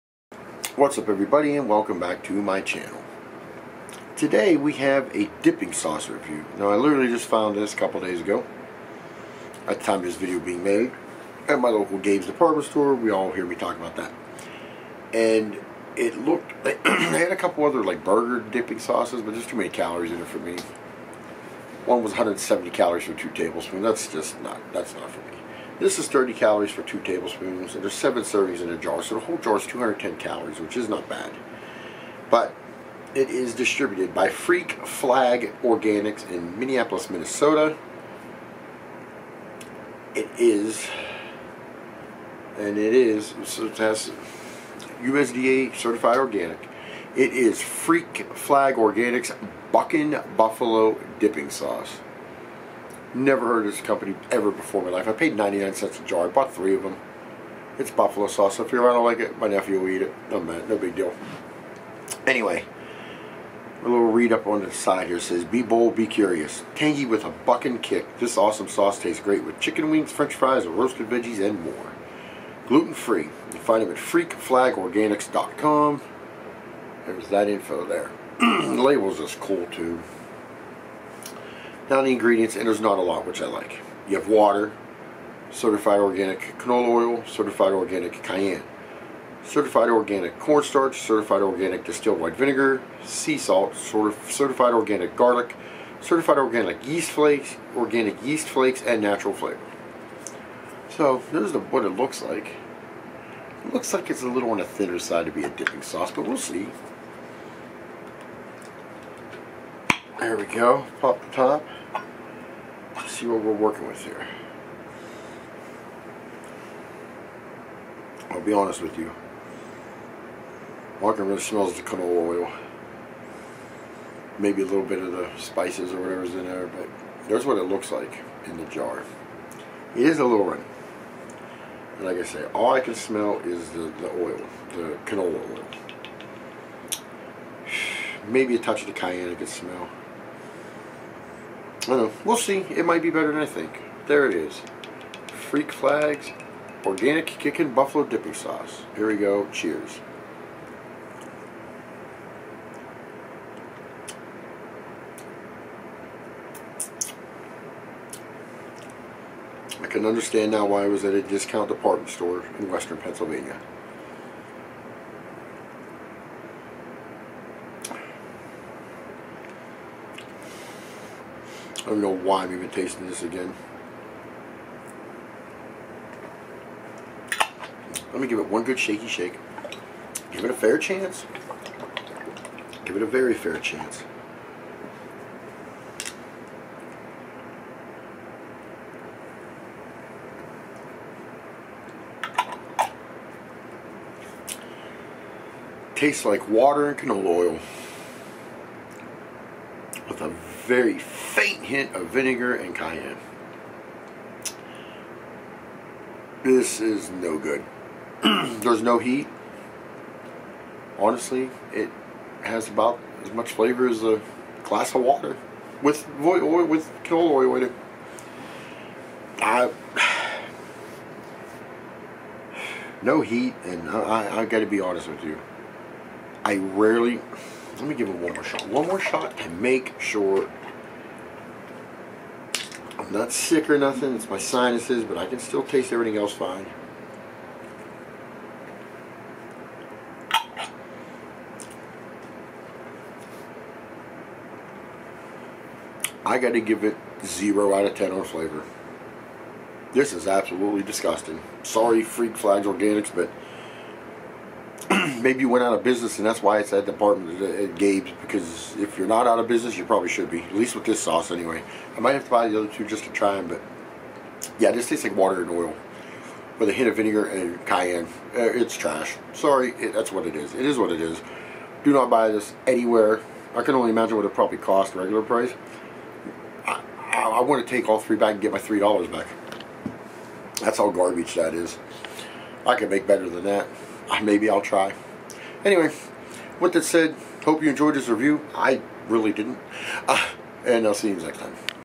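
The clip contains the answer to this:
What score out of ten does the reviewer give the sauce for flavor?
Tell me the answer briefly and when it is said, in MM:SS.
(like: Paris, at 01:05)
0, at 04:07.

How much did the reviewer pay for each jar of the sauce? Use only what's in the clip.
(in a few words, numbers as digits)
99 cents.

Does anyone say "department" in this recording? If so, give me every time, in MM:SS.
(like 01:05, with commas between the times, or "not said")
00:12, 02:41, 04:16.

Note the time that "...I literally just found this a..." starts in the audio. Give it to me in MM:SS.
00:06.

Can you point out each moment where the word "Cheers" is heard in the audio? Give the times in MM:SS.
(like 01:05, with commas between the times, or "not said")
02:29.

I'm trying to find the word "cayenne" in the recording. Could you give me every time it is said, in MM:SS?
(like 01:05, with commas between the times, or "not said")
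01:28, 02:18, 03:22, 04:27.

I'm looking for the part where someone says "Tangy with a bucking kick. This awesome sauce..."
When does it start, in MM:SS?
01:06.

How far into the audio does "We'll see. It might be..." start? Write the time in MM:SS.
02:22.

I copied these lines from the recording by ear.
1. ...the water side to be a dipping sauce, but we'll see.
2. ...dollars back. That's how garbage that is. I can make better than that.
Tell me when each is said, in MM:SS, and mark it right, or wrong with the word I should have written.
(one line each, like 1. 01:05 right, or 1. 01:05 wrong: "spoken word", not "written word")
1. 01:44 wrong: "thinner", not "water"
2. 04:38 right.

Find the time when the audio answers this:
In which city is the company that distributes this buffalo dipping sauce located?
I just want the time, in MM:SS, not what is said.
00:36.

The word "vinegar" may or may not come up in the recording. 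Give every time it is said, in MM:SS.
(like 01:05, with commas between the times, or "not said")
01:32, 03:22, 04:26.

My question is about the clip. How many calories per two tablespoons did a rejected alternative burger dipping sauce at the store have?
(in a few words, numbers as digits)
170.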